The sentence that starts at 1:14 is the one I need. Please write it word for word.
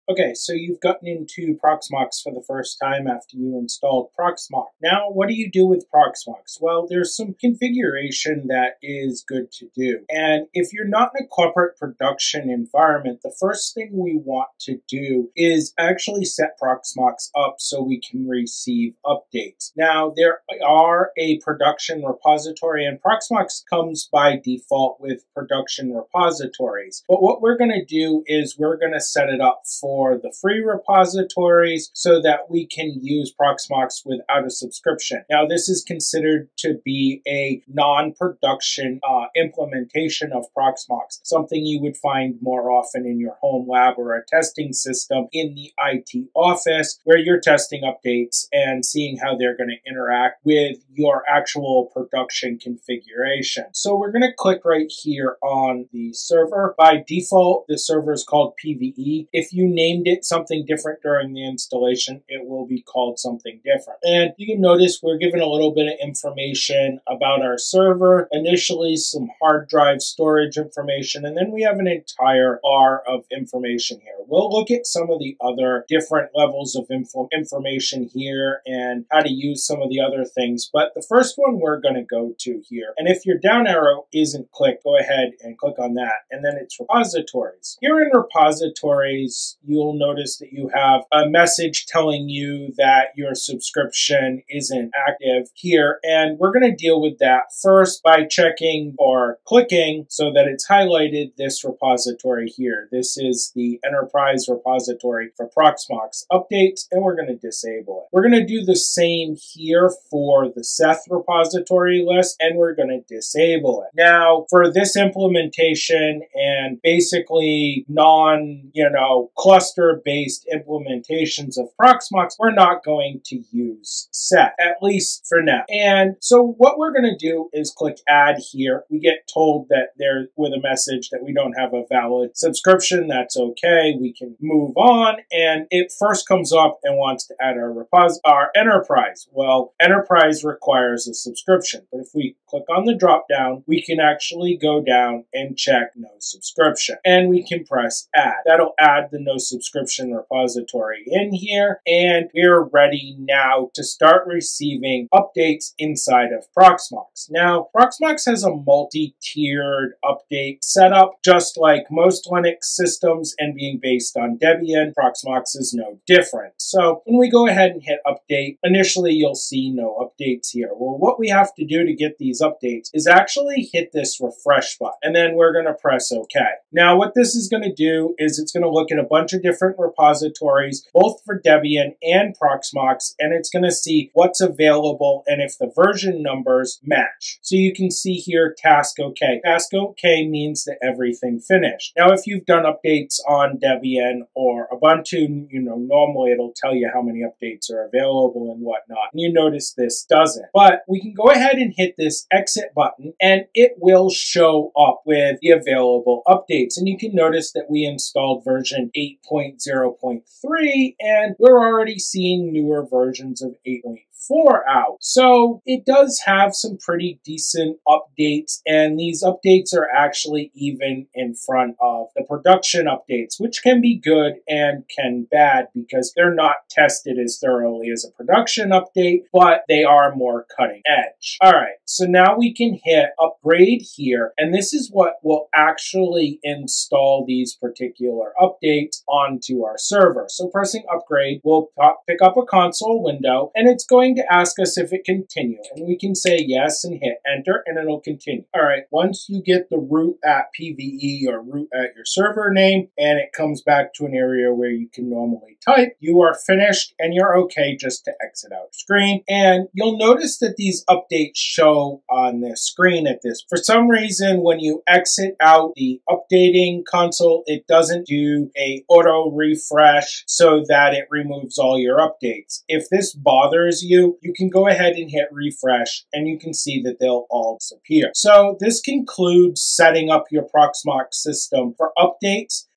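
We'll look at some of the other different levels of info information here and how to use some of the other things.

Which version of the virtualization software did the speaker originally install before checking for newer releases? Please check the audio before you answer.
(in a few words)
8.0.3.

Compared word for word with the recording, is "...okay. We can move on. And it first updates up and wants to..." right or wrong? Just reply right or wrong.
wrong.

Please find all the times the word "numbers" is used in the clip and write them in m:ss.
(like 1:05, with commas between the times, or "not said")
3:06.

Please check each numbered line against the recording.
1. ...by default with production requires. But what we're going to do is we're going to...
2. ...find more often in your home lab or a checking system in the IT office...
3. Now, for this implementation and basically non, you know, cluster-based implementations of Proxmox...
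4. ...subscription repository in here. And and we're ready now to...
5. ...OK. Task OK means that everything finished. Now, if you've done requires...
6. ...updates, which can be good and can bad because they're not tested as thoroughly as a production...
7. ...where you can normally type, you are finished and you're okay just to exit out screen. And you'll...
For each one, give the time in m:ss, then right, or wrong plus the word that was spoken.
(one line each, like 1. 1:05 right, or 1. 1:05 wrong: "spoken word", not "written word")
1. 0:24 wrong: "repositories", not "requires"
2. 0:41 wrong: "testing", not "checking"
3. 1:53 right
4. 2:29 right
5. 3:08 wrong: "updates", not "requires"
6. 3:42 right
7. 4:14 right.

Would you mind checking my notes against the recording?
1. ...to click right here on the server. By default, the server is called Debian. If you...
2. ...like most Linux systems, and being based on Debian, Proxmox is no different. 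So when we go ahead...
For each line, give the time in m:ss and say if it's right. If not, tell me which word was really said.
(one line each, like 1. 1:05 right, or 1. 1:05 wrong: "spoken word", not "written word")
1. 0:54 wrong: "PVE", not "Debian"
2. 2:41 right.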